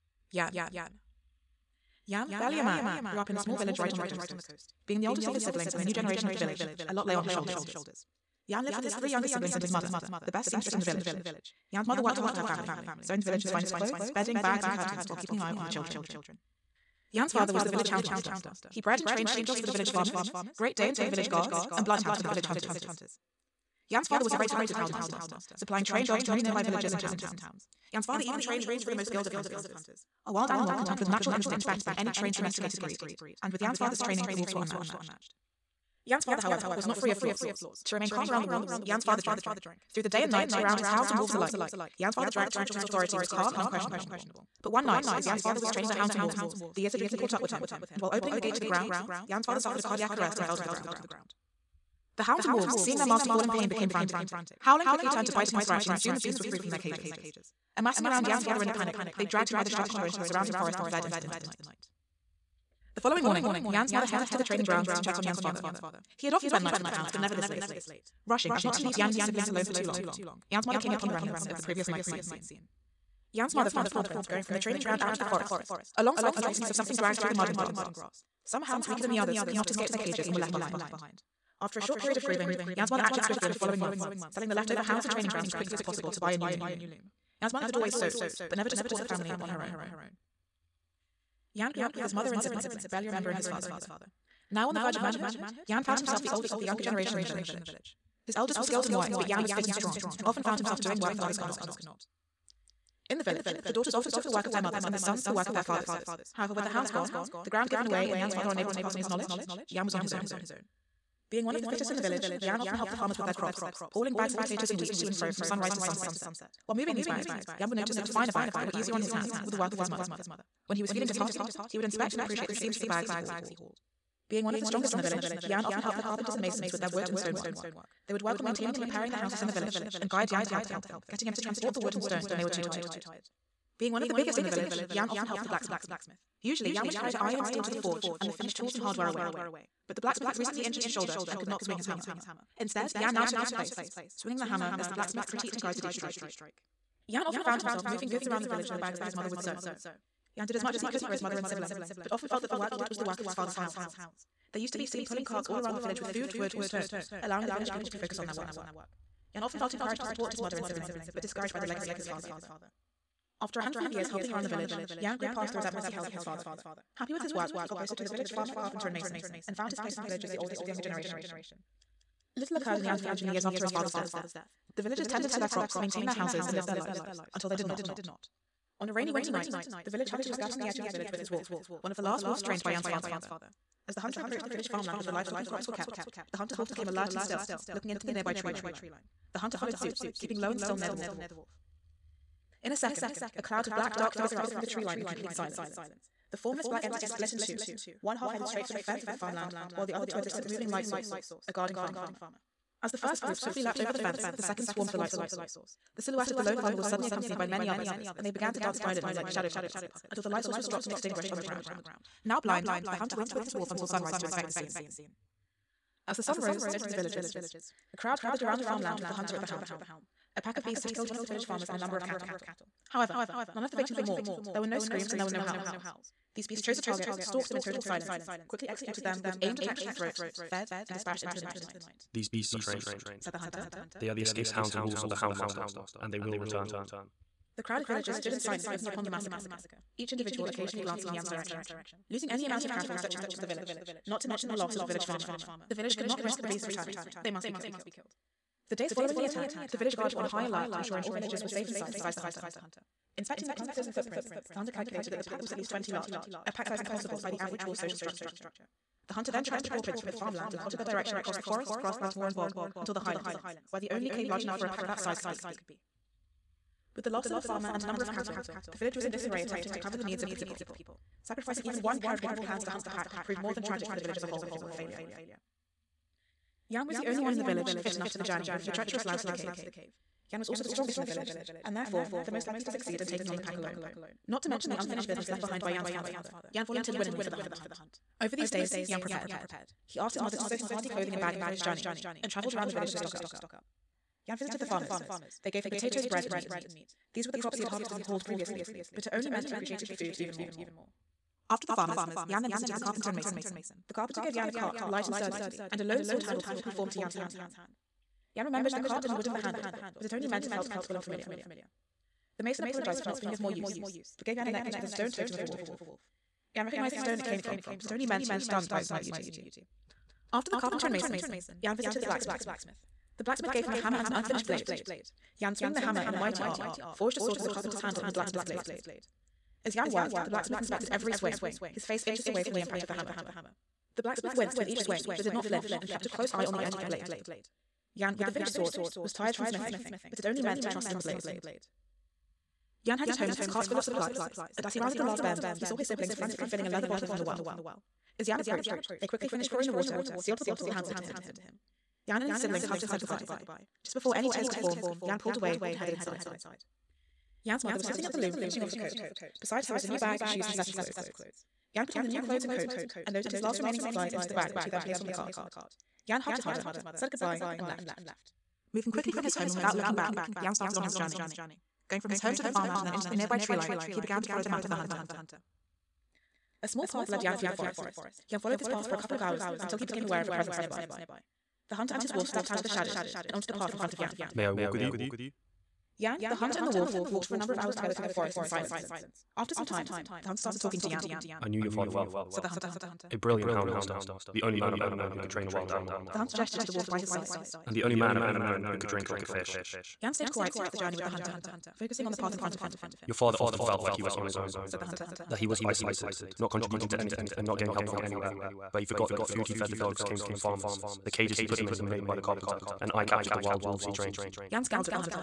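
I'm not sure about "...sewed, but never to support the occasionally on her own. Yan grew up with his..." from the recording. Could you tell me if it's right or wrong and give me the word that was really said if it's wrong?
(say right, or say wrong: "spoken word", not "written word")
wrong: "family", not "occasionally".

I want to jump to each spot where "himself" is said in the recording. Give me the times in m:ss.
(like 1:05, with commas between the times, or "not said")
1:35, 1:40, 2:27.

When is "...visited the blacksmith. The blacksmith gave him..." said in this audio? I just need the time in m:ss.
5:21.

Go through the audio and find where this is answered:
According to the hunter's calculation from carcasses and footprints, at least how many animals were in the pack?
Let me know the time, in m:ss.
4:15.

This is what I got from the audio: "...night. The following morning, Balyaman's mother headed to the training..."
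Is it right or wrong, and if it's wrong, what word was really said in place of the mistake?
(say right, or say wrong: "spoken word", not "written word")
wrong: "Yan", not "Balyaman".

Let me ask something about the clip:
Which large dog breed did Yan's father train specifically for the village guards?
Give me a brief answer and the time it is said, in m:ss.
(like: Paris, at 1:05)
Great Danes, at 0:20.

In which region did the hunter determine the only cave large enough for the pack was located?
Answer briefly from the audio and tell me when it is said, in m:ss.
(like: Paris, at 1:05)
The highlands, at 4:23.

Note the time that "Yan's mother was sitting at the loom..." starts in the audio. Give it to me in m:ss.
5:57.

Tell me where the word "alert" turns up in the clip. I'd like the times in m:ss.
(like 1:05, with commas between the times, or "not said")
3:06, 4:10.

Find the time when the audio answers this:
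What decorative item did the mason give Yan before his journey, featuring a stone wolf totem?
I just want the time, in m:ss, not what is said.
5:14.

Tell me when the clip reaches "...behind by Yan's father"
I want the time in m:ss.
4:45.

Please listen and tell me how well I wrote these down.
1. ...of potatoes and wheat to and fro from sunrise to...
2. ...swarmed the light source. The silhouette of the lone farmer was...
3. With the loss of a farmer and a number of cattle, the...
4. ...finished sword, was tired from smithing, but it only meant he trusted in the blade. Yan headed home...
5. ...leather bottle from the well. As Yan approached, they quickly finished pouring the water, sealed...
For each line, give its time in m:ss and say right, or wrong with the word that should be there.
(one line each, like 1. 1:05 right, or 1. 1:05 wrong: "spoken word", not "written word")
1. 1:54 right
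2. 3:24 right
3. 4:26 right
4. 5:38 right
5. 5:46 right.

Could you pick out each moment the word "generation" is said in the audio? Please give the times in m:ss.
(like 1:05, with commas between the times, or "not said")
0:05, 1:36, 2:50.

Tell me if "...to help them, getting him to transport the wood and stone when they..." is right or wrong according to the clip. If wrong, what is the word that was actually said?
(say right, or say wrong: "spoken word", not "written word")
right.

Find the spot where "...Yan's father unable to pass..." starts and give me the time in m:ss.
1:48.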